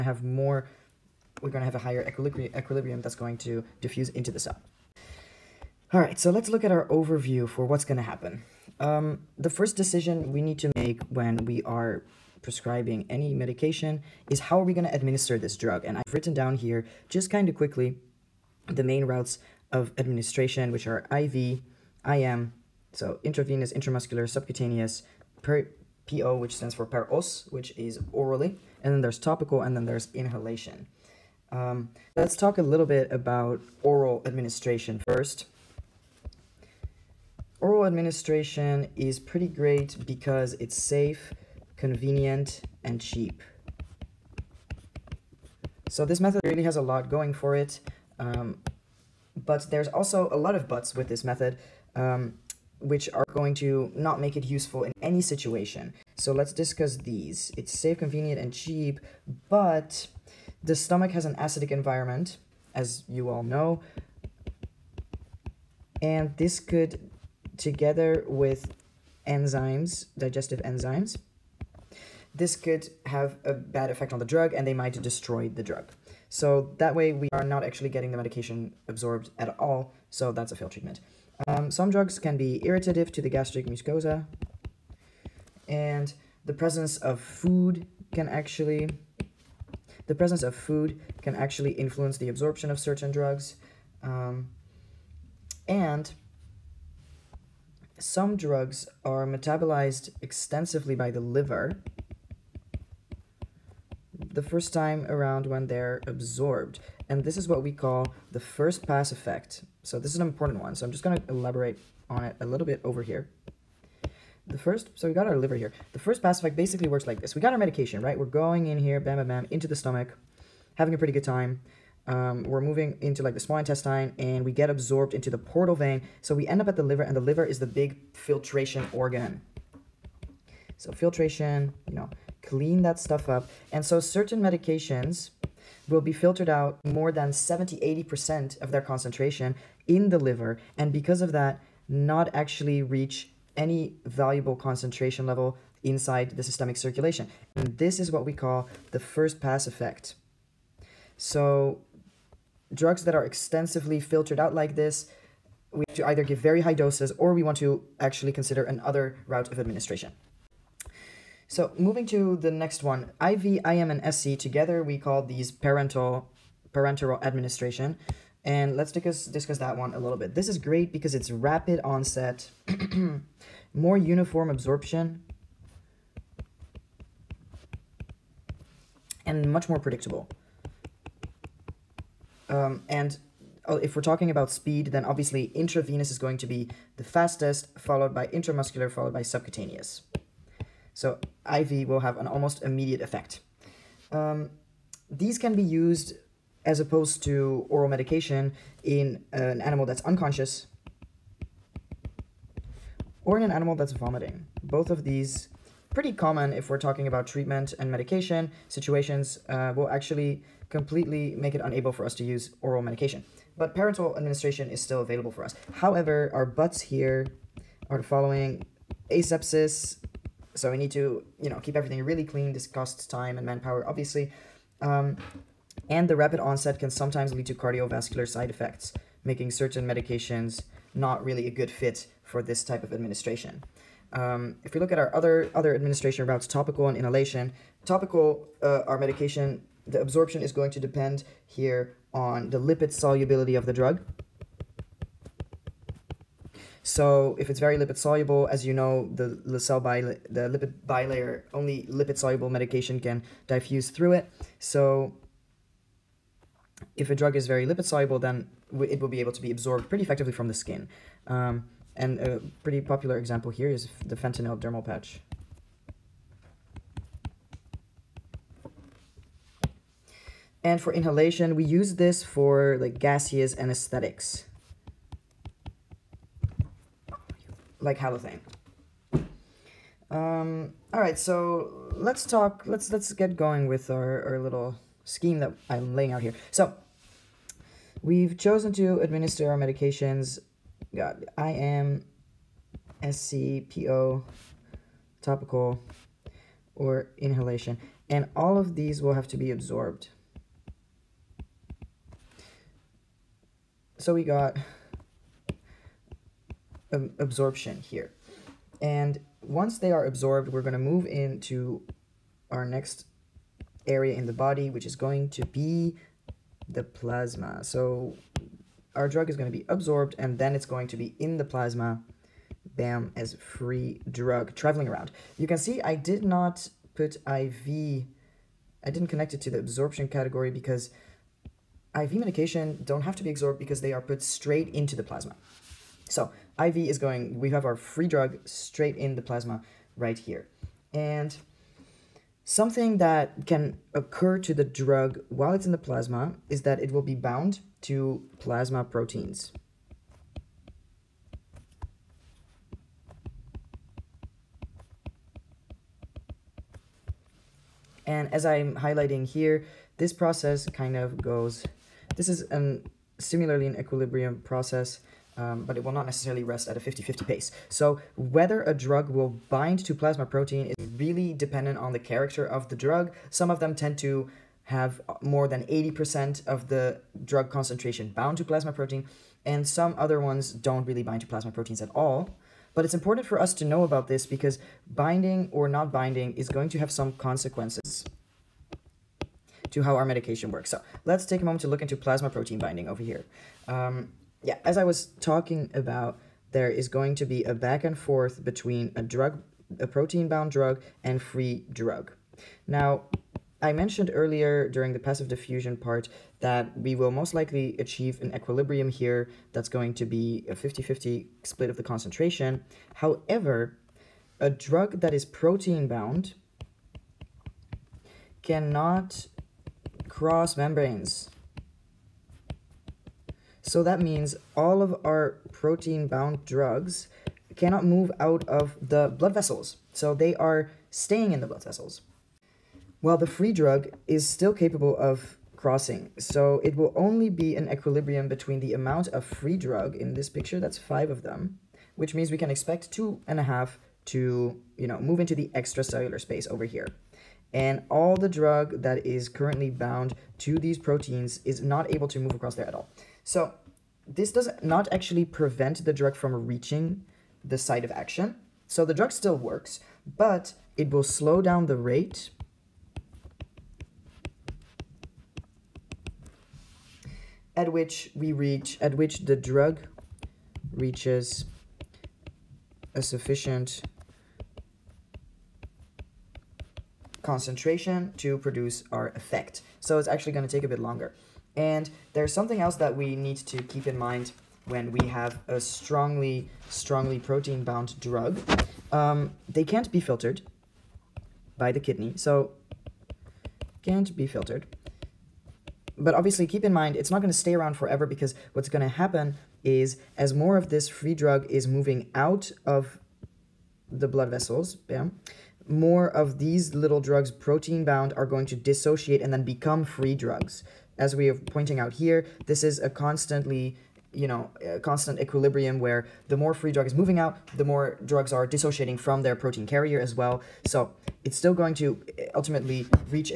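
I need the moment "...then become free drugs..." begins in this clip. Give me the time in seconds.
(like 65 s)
509 s.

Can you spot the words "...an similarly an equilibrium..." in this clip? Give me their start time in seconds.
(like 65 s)
362 s.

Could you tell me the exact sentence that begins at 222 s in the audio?
This costs time and manpower, obviously.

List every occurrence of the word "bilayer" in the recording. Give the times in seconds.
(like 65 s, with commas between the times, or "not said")
250 s.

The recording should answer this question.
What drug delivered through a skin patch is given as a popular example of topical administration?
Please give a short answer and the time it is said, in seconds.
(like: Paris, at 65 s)
fentanyl, at 264 s.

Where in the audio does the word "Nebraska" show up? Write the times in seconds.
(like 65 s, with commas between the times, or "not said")
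not said.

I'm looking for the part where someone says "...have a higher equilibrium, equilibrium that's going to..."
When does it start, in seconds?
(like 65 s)
1 s.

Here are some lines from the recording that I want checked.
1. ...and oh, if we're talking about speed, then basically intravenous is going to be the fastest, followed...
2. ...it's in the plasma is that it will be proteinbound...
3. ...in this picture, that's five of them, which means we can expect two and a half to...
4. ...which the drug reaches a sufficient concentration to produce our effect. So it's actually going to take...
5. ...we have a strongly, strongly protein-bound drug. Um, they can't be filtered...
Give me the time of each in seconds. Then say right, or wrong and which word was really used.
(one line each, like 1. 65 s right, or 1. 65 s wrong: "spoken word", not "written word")
1. 182 s wrong: "obviously", not "basically"
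2. 345 s wrong: "bound", not "proteinbound"
3. 439 s right
4. 468 s right
5. 484 s right.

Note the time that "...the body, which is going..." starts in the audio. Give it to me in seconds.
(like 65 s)
314 s.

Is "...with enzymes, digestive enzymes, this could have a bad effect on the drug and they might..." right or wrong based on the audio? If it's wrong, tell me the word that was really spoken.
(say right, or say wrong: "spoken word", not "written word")
right.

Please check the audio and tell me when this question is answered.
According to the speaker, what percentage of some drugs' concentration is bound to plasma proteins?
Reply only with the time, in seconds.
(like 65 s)
375 s.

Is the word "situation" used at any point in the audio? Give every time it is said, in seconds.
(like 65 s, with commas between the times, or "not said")
55 s, 208 s.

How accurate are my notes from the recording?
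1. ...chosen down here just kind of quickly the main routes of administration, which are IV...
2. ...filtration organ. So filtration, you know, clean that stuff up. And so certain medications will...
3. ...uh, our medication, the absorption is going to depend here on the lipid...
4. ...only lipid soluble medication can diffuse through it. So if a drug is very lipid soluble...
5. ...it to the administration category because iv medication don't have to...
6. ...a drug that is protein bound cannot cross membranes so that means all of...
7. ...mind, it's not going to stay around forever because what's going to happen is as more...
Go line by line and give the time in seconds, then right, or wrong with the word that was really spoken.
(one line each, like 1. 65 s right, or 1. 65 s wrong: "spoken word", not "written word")
1. 16 s wrong: "written", not "chosen"
2. 128 s right
3. 238 s right
4. 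251 s right
5. 329 s wrong: "absorption", not "administration"
6. 414 s right
7. 496 s right.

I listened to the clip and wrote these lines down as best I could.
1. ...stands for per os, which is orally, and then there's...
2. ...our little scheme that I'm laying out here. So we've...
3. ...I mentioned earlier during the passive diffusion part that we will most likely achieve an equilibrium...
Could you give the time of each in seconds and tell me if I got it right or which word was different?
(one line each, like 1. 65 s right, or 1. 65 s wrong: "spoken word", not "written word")
1. 26 s right
2. 284 s right
3. 403 s right.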